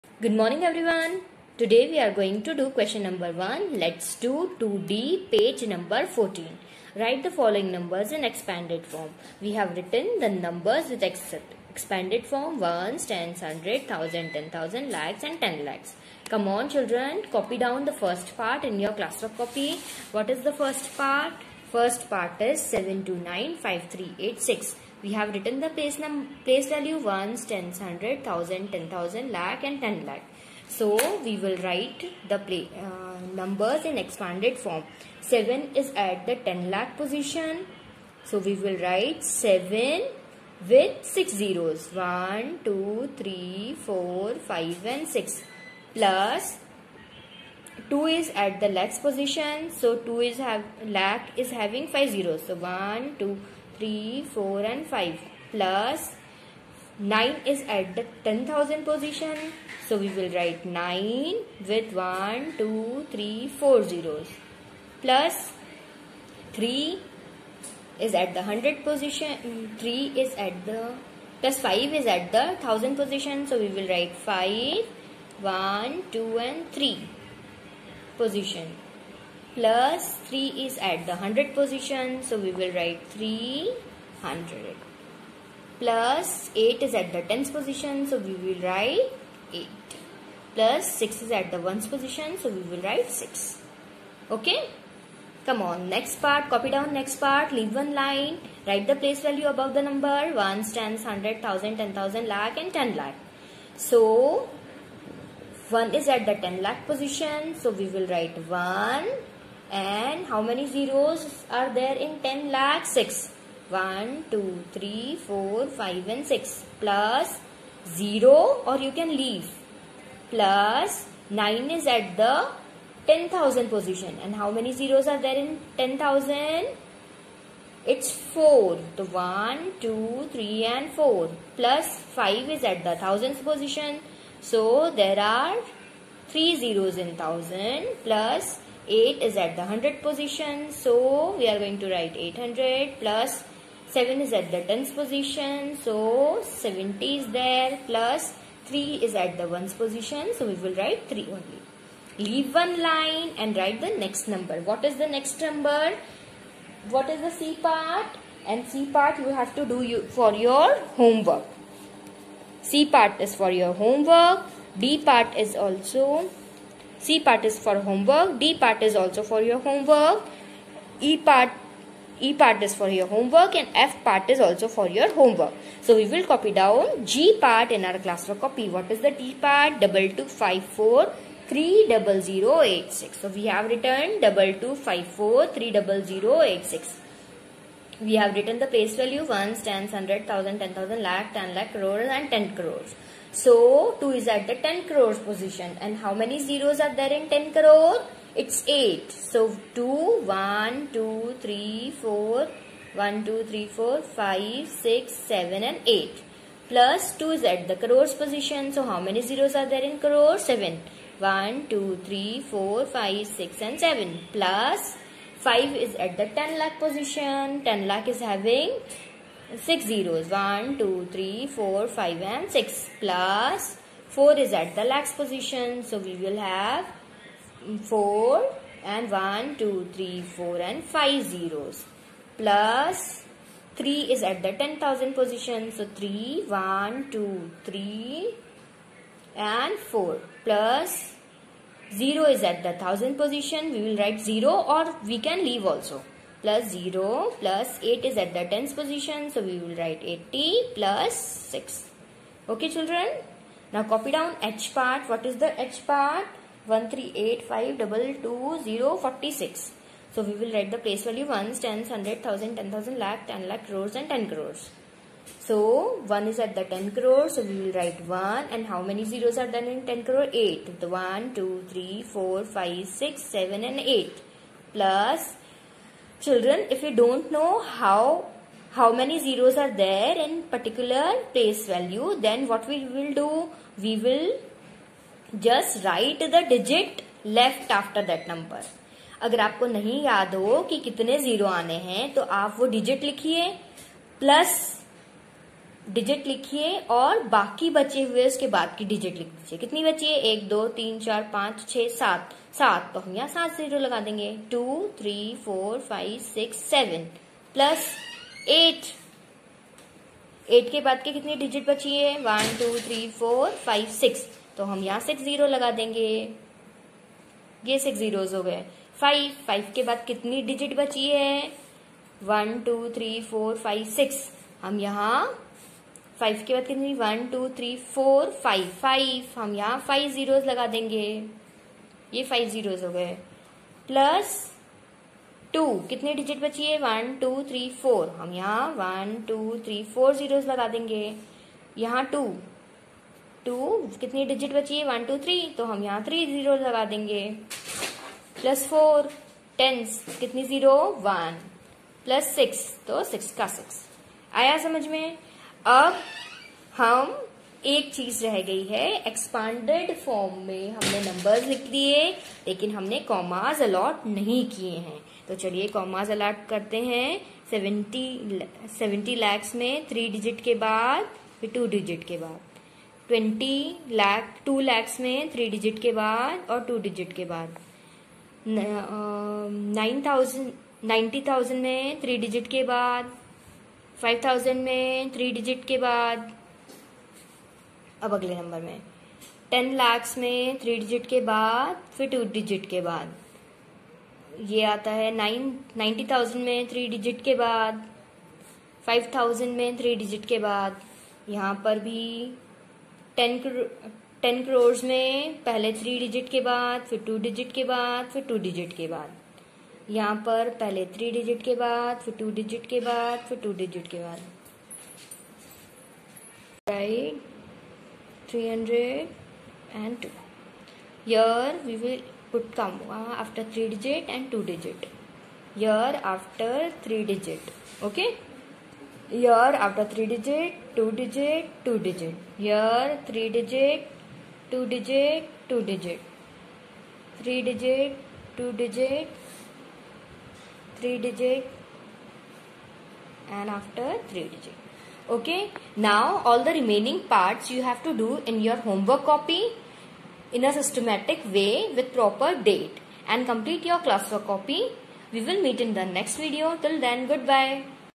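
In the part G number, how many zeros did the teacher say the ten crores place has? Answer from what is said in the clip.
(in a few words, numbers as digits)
8.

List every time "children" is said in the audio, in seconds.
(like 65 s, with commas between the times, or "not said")
16 s, 252 s, 276 s.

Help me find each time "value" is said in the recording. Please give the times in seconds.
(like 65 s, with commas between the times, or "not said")
26 s, 99 s, 189 s, 261 s, 281 s.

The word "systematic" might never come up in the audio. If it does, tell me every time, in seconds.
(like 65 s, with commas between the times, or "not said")
450 s.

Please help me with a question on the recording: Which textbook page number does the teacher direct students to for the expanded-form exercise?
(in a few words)
14.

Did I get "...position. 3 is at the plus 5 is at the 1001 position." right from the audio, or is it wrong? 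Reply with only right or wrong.
wrong.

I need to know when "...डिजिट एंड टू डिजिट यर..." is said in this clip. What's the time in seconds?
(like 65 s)
423 s.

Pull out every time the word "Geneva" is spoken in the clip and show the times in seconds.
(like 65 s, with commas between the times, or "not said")
not said.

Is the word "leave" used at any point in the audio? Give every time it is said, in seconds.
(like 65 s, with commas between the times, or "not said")
97 s, 119 s, 152 s, 245 s.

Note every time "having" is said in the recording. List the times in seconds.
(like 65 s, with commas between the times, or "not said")
51 s, 218 s.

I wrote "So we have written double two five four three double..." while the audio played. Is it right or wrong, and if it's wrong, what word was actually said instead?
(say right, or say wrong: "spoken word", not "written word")
right.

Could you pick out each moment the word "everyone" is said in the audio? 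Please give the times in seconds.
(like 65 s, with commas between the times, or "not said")
0 s.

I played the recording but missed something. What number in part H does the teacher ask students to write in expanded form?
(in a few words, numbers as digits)
138522046.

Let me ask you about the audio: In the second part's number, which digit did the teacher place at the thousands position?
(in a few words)
5.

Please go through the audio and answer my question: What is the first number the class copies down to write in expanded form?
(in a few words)
7295386.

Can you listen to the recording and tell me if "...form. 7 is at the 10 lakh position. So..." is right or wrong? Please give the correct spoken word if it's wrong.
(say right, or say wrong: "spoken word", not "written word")
right.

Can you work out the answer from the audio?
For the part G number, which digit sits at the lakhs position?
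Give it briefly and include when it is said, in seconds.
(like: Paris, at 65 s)
4, at 223 s.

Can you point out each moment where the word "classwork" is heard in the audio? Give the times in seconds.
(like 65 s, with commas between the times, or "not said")
19 s, 178 s, 453 s.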